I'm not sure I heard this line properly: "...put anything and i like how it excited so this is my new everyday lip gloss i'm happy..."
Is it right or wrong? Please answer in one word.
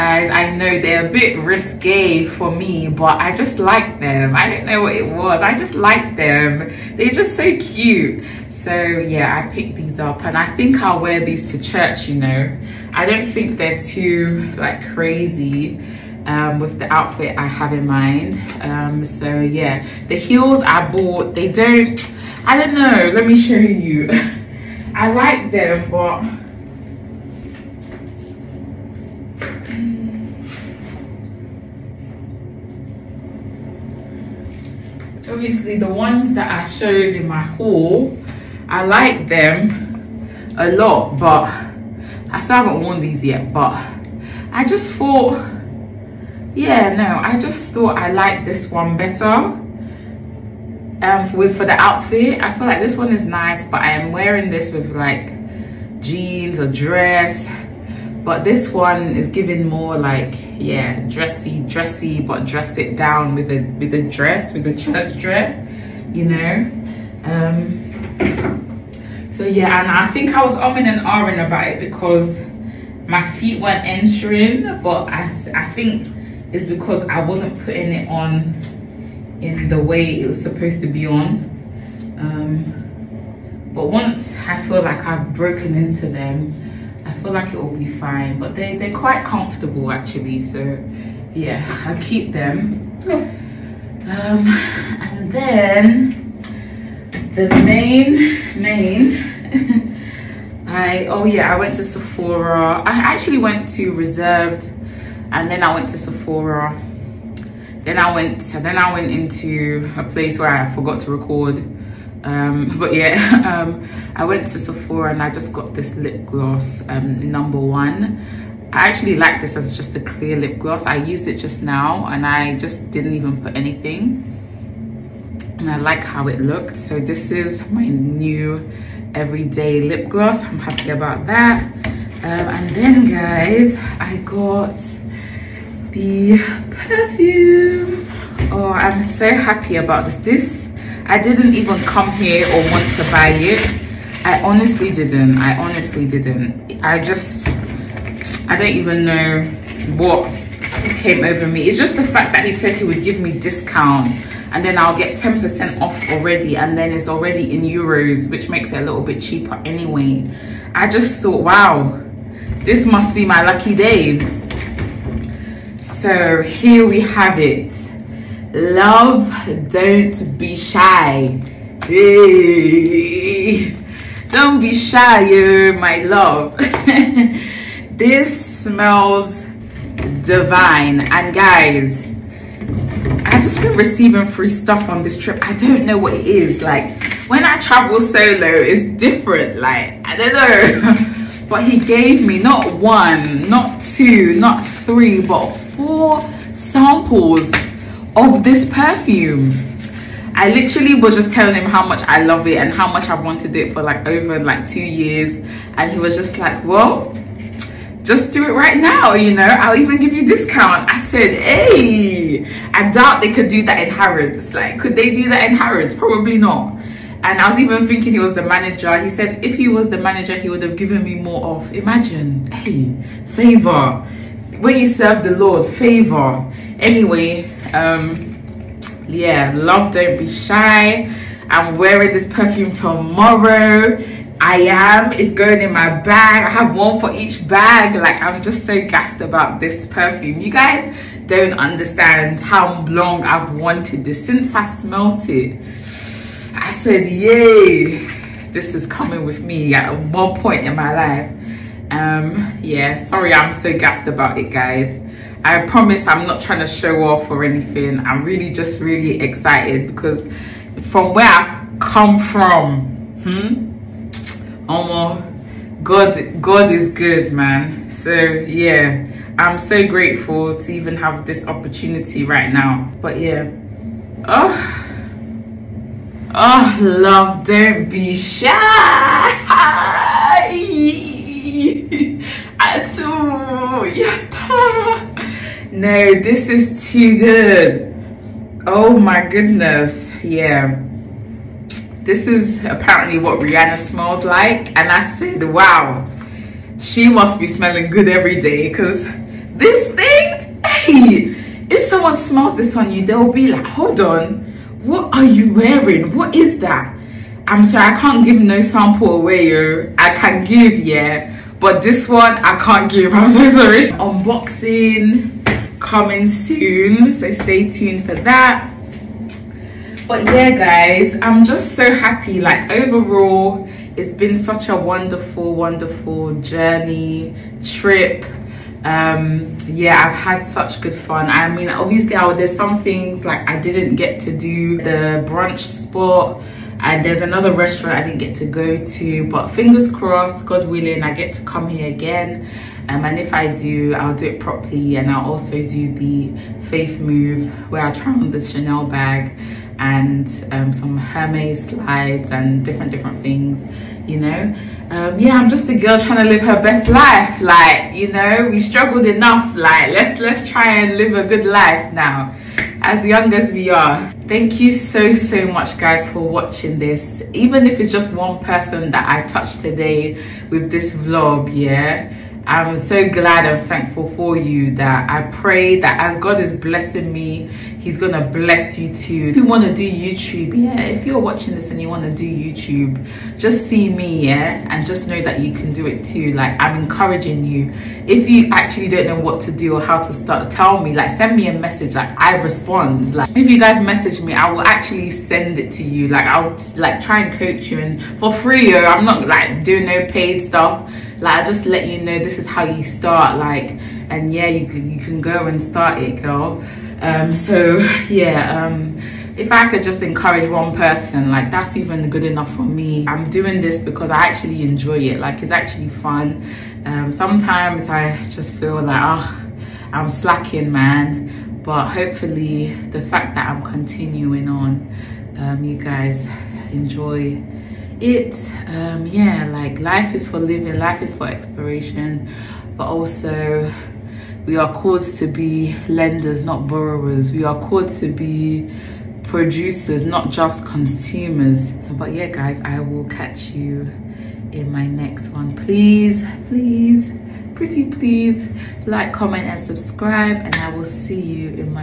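wrong.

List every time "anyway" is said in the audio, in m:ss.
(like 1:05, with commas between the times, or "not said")
2:39, 3:46.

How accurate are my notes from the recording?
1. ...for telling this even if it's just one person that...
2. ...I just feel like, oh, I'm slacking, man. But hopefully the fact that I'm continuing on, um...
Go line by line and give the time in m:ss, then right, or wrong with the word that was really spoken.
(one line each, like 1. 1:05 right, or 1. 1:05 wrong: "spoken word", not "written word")
1. 6:06 wrong: "watching", not "telling"
2. 6:57 right.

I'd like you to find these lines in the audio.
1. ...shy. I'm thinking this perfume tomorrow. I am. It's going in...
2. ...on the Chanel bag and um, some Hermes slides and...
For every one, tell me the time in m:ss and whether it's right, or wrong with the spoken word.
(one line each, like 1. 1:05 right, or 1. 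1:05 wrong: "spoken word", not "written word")
1. 3:50 wrong: "wearing", not "thinking"
2. 5:48 right.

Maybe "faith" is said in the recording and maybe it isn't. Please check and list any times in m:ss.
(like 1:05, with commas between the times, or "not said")
5:46.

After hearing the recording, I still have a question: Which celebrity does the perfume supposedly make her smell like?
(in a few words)
Rihanna.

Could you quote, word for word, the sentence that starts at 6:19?
If you wanna do YouTube, yeah, if you're watching this and you wanna do YouTube, just see me, yeah?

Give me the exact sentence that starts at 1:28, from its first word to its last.
But they, they're quite comfortable actually.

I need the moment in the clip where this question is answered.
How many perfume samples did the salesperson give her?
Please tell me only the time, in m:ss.
3:15.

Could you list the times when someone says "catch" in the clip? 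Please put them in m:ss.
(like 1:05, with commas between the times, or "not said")
7:23.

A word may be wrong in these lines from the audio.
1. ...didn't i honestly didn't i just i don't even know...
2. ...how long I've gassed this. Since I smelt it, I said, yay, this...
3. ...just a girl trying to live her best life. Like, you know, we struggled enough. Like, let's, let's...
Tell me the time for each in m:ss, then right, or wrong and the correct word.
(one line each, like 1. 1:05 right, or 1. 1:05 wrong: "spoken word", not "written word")
1. 2:24 right
2. 4:02 wrong: "wanted", not "gassed"
3. 5:55 right.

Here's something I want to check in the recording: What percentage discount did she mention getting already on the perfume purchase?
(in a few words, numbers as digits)
10%.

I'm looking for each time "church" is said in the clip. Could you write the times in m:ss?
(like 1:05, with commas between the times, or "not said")
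0:11, 1:04.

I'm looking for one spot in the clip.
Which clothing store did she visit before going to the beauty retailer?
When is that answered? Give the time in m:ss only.
1:43.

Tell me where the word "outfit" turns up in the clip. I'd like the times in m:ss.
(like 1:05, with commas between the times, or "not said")
0:16, 0:51.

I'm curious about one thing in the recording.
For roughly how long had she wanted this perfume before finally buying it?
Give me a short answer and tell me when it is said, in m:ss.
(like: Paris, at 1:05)
2 years, at 3:24.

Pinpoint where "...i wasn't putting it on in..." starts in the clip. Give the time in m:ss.
1:17.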